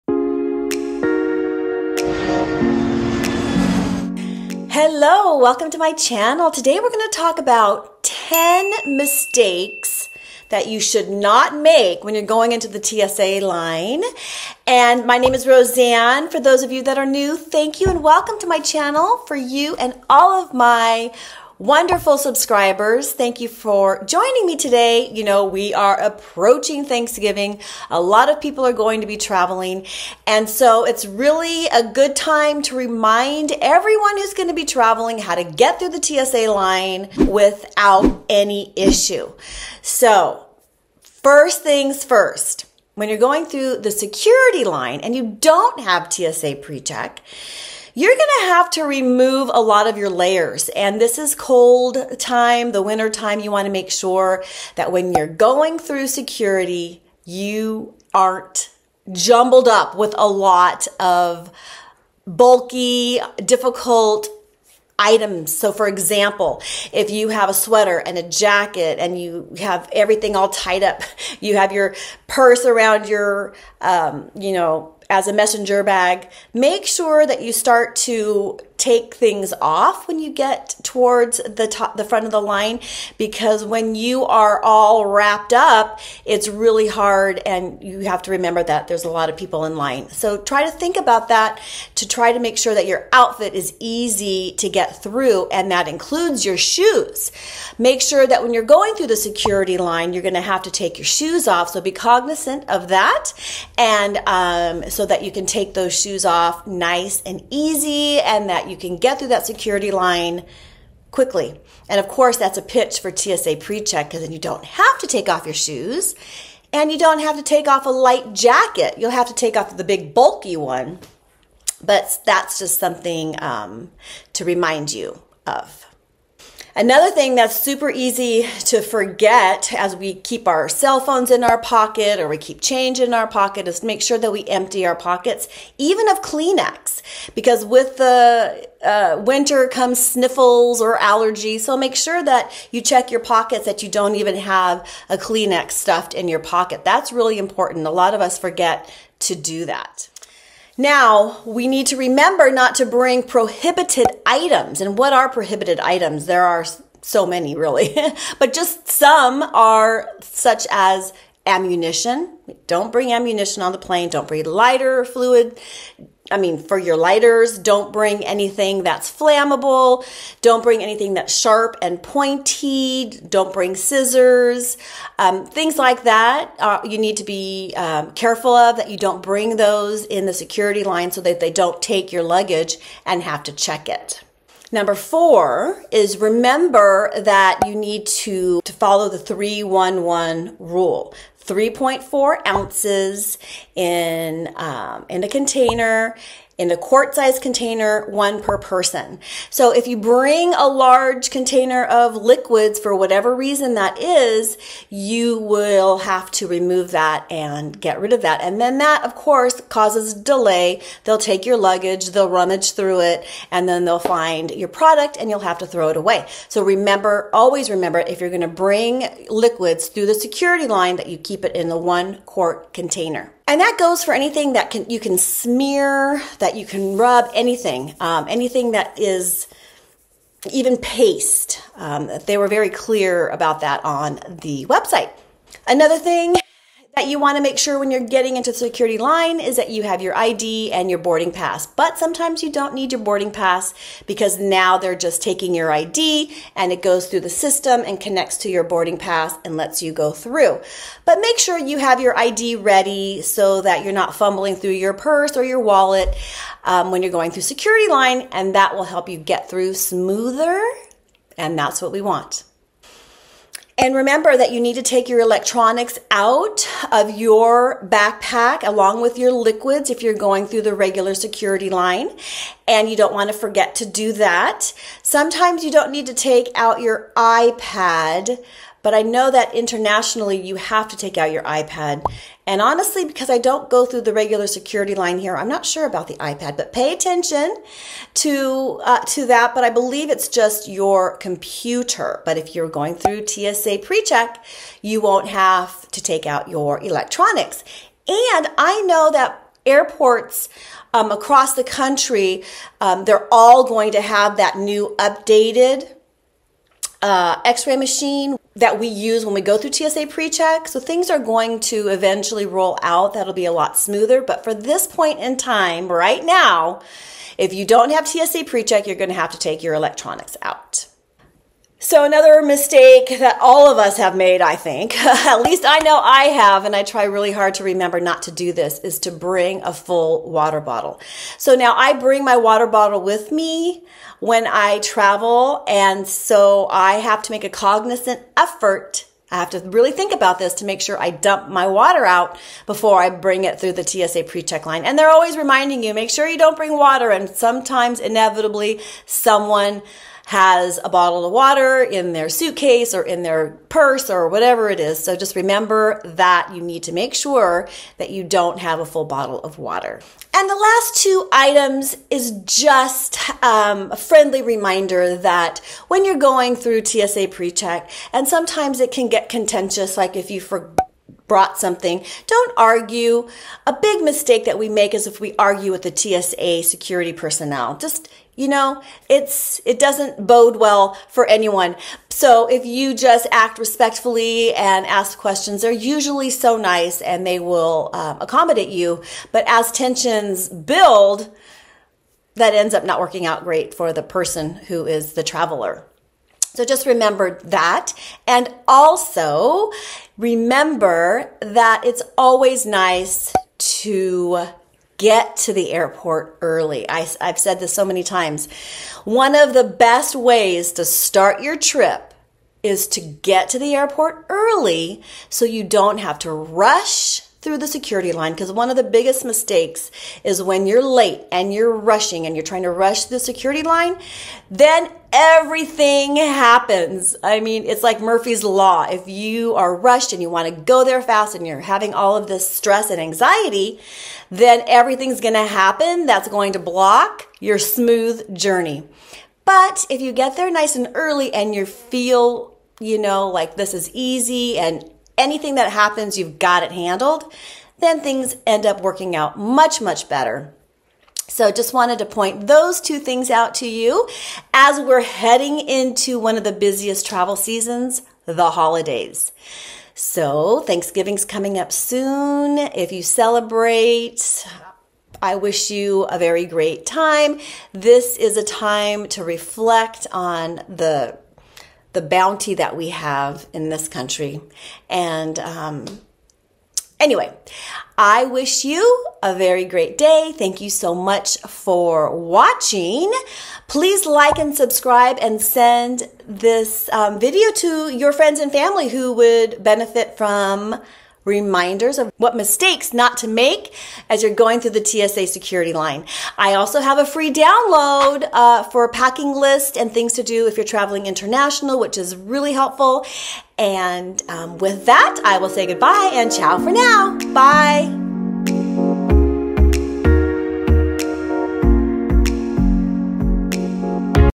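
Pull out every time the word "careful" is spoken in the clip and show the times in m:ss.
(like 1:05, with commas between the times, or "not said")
2:58.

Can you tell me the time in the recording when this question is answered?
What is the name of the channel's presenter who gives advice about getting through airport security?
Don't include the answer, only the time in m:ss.
0:15.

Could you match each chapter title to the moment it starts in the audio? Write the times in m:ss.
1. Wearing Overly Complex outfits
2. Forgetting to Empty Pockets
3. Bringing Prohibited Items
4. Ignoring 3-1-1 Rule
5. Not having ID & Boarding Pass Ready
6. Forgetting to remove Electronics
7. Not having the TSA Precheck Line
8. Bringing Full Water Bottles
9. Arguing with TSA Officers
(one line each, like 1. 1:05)
1. 0:40
2. 2:06
3. 2:30
4. 3:04
5. 3:55
6. 4:23
7. 4:51
8. 5:22
9. 6:00.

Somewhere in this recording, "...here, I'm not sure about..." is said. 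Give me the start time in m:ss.
4:45.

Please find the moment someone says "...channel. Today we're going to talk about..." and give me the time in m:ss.
0:05.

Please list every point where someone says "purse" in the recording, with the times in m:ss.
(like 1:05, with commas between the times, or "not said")
1:12, 4:14, 5:53.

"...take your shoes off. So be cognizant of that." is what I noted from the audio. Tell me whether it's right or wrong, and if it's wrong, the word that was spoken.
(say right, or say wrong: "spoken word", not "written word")
right.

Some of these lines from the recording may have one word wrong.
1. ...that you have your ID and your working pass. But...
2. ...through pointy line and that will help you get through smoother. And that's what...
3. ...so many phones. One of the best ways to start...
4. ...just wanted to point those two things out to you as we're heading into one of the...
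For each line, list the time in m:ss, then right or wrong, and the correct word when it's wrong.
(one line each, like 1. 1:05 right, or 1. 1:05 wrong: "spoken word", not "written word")
1. 3:59 wrong: "boarding", not "working"
2. 4:17 wrong: "security", not "pointy"
3. 6:47 wrong: "times", not "phones"
4. 7:31 right.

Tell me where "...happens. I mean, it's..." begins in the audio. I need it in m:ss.
7:06.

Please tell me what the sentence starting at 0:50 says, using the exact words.
And this is cold time, the winter time.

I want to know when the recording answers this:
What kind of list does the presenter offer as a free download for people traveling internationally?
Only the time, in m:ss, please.
8:18.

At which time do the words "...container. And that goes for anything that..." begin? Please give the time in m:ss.
3:42.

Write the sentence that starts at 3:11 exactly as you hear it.
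3.4 ounces in, um, in a container, in a quart size container, one per person.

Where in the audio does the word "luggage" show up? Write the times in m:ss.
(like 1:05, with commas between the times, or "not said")
3:02, 3:31.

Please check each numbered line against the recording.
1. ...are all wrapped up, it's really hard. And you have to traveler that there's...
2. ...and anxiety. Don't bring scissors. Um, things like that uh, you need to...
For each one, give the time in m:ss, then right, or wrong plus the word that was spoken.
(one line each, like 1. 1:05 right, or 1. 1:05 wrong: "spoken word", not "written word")
1. 1:24 wrong: "remember", not "traveler"
2. 2:51 wrong: "pointy", not "anxiety".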